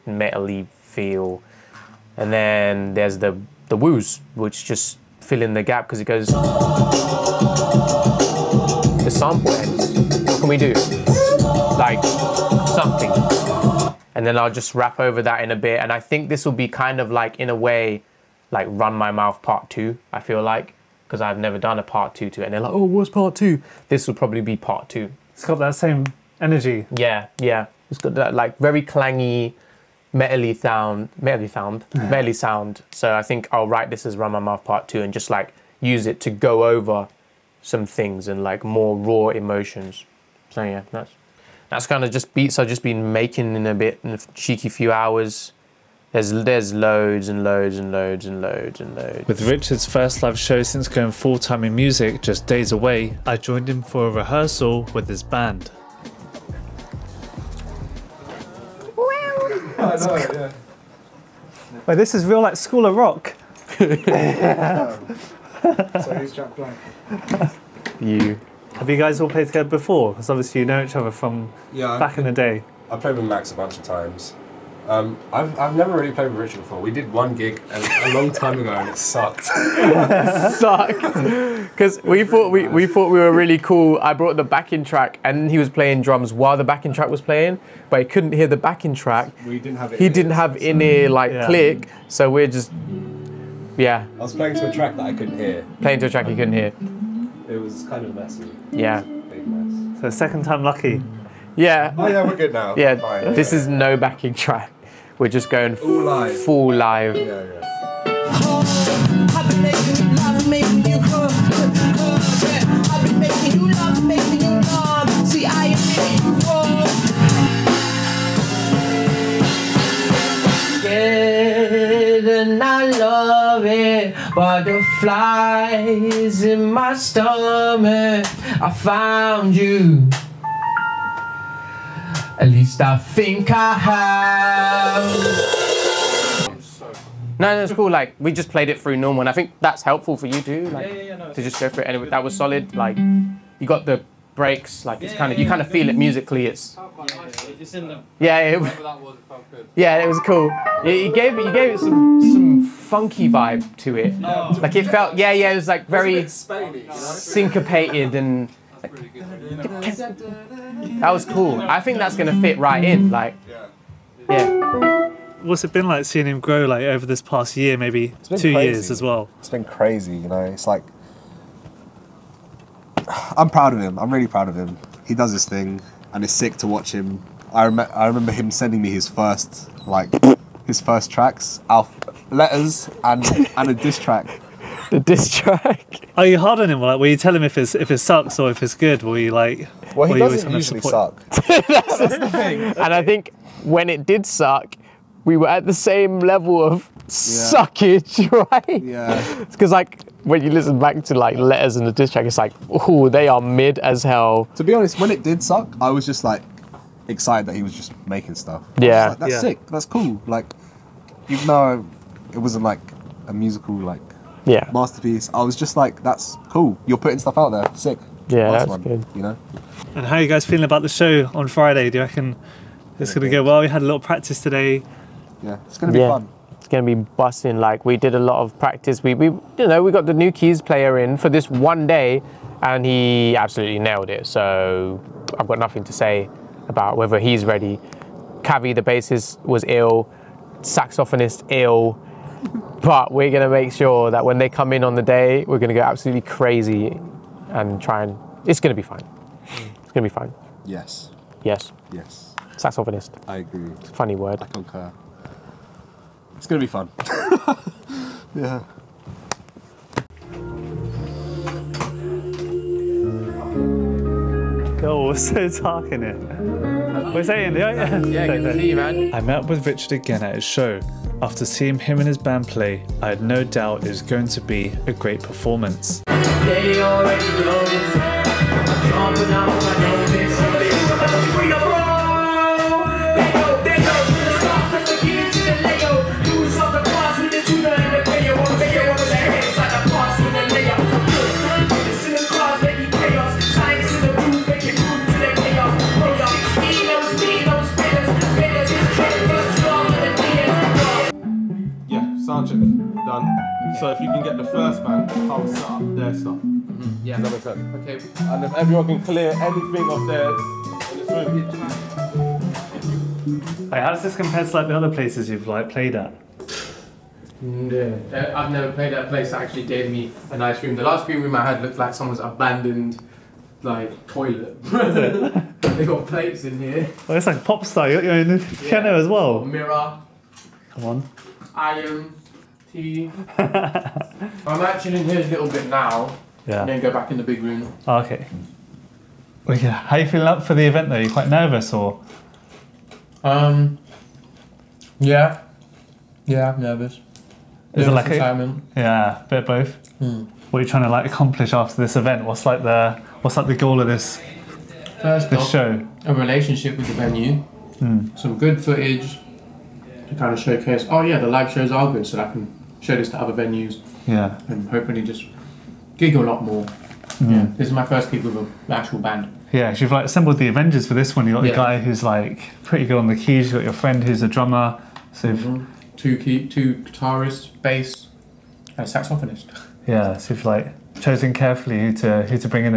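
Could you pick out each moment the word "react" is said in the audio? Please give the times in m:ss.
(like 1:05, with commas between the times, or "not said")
not said.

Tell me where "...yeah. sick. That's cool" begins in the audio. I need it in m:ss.
3:29.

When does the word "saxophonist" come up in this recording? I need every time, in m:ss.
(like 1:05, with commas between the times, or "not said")
4:00, 4:12, 6:18.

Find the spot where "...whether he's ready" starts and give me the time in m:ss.
3:56.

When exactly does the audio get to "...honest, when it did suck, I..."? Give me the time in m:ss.
3:24.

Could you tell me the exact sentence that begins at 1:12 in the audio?
I played with Max a bunch of times.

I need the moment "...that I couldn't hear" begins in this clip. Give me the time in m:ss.
1:34.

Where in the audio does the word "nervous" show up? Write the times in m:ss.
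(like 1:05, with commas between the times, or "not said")
5:41, 5:46.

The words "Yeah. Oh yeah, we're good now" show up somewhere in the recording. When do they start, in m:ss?
1:41.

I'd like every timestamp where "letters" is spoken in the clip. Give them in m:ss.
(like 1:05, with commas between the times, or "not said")
3:02, 3:21.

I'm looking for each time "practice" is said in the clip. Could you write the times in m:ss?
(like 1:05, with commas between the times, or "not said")
3:43, 3:48.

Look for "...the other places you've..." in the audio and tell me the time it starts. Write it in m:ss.
5:14.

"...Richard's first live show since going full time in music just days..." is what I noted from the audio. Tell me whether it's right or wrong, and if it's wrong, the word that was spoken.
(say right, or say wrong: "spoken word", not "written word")
right.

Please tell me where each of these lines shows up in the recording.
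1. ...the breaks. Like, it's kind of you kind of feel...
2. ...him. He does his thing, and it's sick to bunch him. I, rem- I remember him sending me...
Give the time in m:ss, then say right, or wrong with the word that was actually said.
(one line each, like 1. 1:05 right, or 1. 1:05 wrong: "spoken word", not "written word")
1. 2:23 right
2. 2:54 wrong: "watch", not "bunch".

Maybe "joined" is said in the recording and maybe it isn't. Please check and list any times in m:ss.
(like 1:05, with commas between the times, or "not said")
0:53.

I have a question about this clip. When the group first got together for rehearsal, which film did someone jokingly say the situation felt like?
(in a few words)
School of Rock.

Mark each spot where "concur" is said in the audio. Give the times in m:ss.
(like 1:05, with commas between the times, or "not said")
4:14.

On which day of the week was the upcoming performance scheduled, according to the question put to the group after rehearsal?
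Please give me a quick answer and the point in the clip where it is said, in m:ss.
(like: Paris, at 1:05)
Friday, at 3:41.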